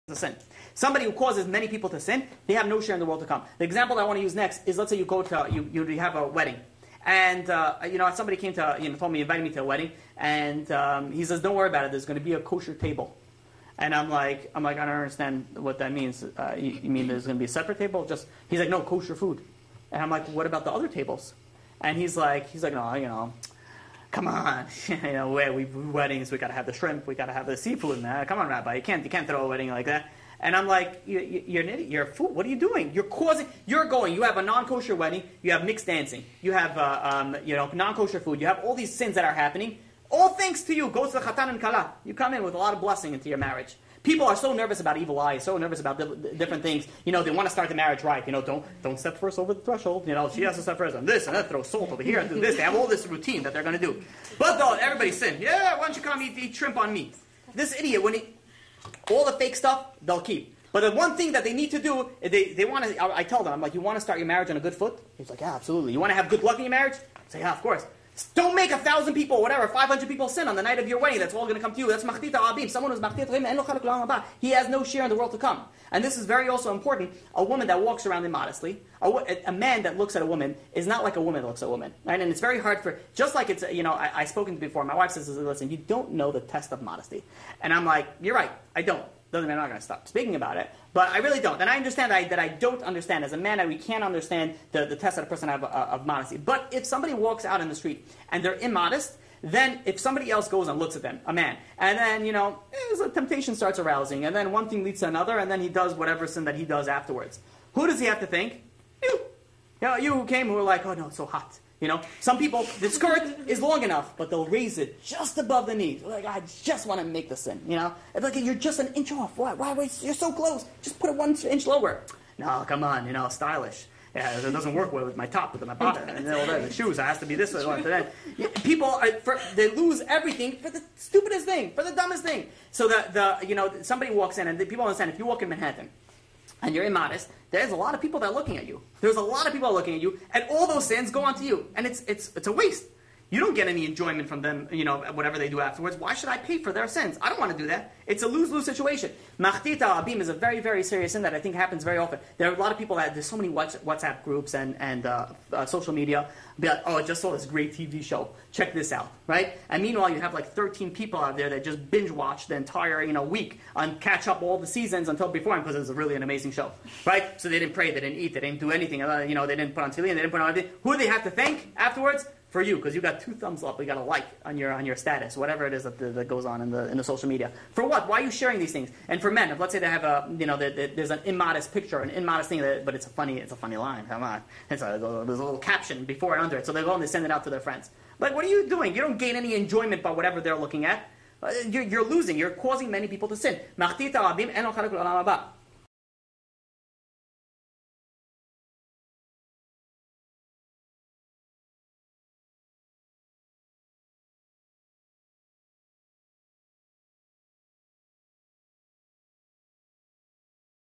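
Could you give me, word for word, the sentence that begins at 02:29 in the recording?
Machtita abim is a very, very serious sin that I think happens very often.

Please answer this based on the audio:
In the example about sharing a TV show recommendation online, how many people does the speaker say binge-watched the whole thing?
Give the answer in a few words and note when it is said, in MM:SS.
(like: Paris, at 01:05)
13, at 02:40.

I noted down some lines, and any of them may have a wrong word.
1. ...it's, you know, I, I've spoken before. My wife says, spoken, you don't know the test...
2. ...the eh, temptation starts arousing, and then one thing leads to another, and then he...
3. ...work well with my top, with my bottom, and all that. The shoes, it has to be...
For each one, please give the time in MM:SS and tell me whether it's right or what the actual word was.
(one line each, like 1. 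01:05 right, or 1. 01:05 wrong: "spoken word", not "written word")
1. 01:23 wrong: "listen", not "spoken"
2. 01:42 right
3. 02:04 right.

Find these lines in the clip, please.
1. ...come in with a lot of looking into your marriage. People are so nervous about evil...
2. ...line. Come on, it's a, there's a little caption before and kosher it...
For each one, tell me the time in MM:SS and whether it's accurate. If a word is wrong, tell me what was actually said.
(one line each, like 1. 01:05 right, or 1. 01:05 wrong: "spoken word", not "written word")
1. 00:42 wrong: "blessing", not "looking"
2. 03:03 wrong: "under", not "kosher".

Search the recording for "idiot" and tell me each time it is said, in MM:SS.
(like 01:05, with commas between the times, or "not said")
00:31, 00:57.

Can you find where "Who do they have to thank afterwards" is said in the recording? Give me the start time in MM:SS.
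02:50.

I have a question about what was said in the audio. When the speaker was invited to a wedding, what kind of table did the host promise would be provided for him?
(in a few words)
Kosher table.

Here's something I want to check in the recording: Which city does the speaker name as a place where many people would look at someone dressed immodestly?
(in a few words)
Manhattan.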